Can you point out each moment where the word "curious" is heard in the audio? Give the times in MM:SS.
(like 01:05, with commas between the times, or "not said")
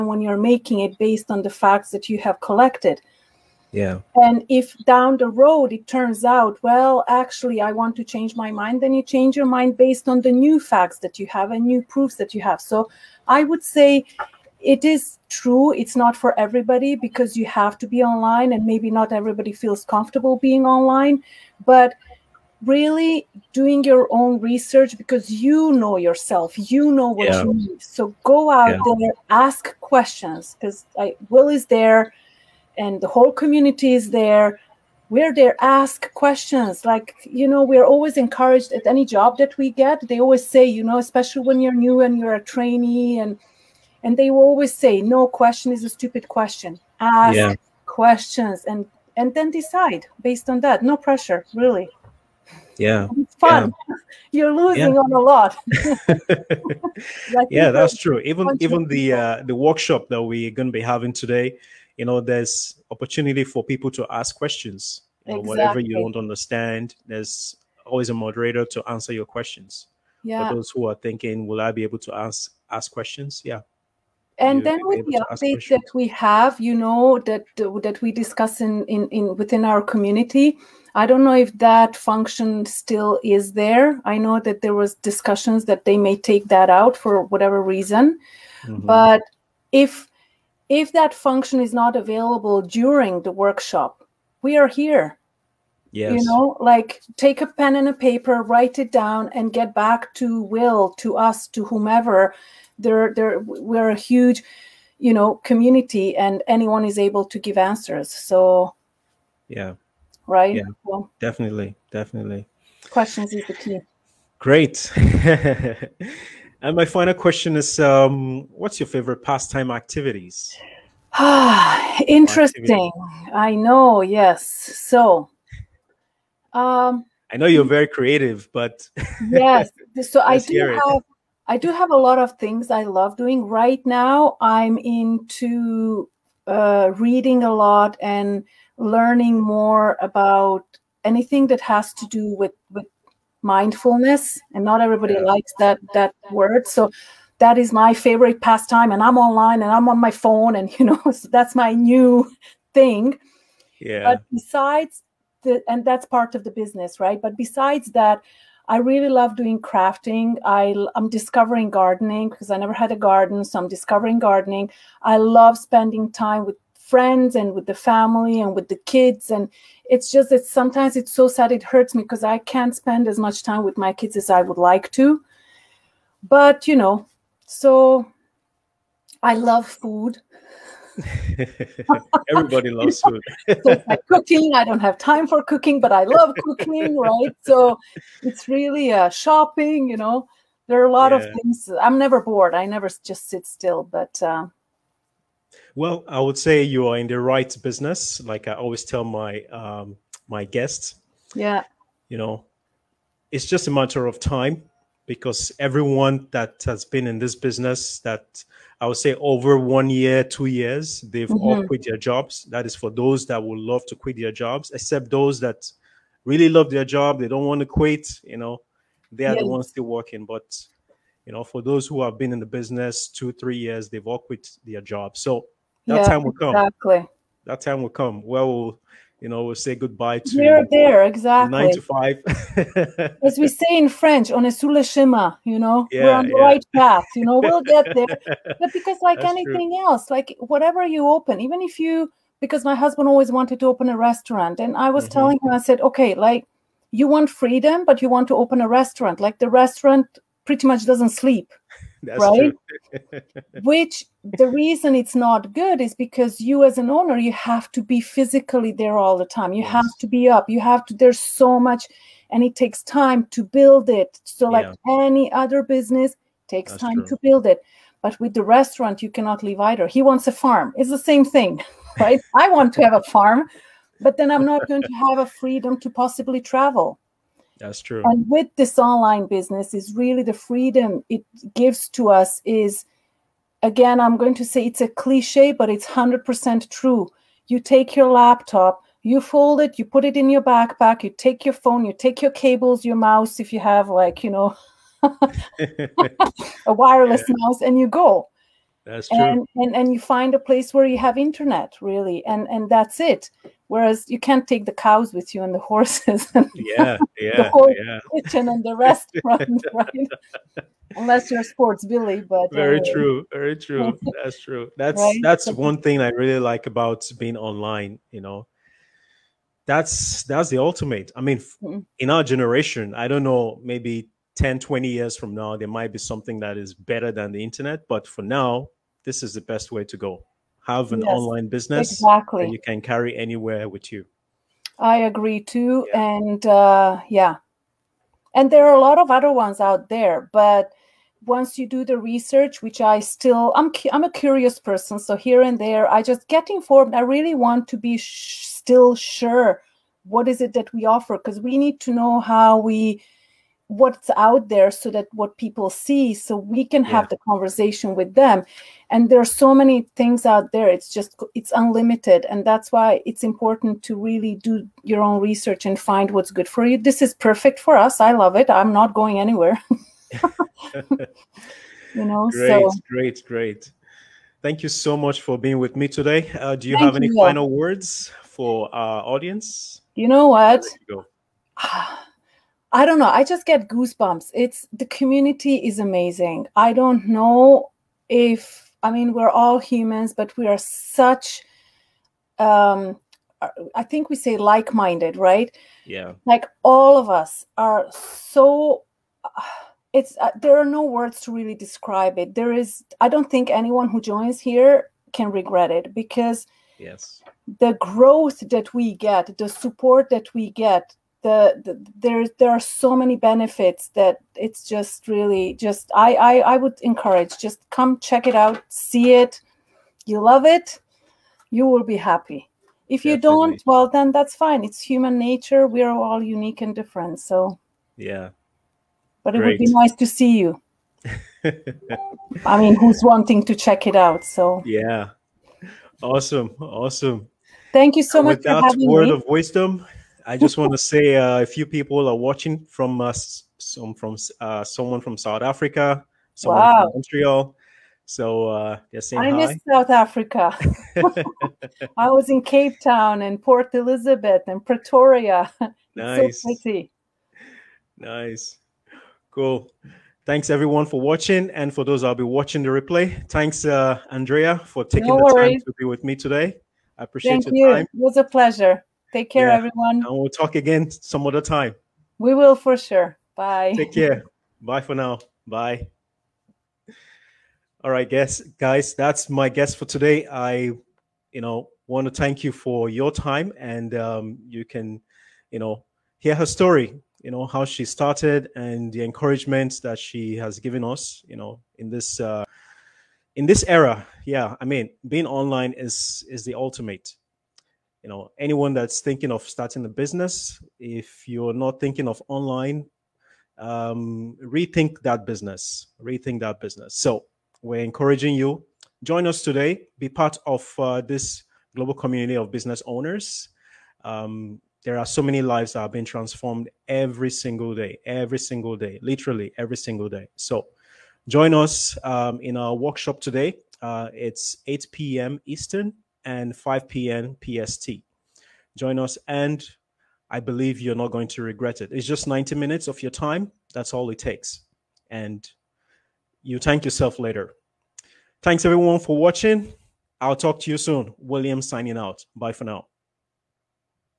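05:44.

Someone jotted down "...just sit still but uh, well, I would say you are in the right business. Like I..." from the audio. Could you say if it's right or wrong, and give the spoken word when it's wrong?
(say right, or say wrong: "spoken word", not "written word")
right.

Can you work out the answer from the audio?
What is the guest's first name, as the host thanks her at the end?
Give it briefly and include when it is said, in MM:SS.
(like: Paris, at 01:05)
Andrea, at 07:44.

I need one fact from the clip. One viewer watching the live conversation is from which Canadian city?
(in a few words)
Montreal.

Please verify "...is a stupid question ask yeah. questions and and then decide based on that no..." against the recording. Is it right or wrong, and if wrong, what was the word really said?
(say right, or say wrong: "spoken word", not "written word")
right.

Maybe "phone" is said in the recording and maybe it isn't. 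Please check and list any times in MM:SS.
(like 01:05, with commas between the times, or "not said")
02:30, 04:51.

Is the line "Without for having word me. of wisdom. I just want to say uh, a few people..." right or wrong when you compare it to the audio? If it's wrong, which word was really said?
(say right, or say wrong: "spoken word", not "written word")
right.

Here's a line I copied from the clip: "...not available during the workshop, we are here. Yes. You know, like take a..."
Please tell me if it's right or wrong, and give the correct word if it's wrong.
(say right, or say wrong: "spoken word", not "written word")
right.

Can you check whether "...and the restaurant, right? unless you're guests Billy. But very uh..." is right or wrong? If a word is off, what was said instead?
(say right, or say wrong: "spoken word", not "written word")
wrong: "sports", not "guests".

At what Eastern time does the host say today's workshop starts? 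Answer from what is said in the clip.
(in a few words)
8 p.m.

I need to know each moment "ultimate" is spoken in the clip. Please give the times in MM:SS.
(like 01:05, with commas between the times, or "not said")
05:20, 08:16.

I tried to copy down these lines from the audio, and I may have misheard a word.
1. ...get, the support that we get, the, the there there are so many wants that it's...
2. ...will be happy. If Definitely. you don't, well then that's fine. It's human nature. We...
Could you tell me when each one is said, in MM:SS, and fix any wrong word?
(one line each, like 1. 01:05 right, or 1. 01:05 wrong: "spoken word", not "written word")
1. 06:48 wrong: "benefits", not "wants"
2. 07:01 right.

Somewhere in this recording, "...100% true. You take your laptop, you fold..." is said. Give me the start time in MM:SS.
04:45.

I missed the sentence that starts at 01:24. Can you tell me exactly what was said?
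I know that there was discussions that they may take that out for whatever reason.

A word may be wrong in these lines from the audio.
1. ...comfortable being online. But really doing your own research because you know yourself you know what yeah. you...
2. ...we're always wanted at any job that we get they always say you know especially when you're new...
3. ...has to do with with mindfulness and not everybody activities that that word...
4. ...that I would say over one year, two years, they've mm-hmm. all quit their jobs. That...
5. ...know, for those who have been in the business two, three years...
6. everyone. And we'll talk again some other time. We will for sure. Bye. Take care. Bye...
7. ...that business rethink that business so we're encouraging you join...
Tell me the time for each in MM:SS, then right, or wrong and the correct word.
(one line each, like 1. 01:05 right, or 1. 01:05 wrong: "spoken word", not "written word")
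1. 00:19 right
2. 00:37 wrong: "encouraged", not "wanted"
3. 02:21 wrong: "likes", not "activities"
4. 03:28 right
5. 03:41 right
6. 07:49 right
7. 08:25 right.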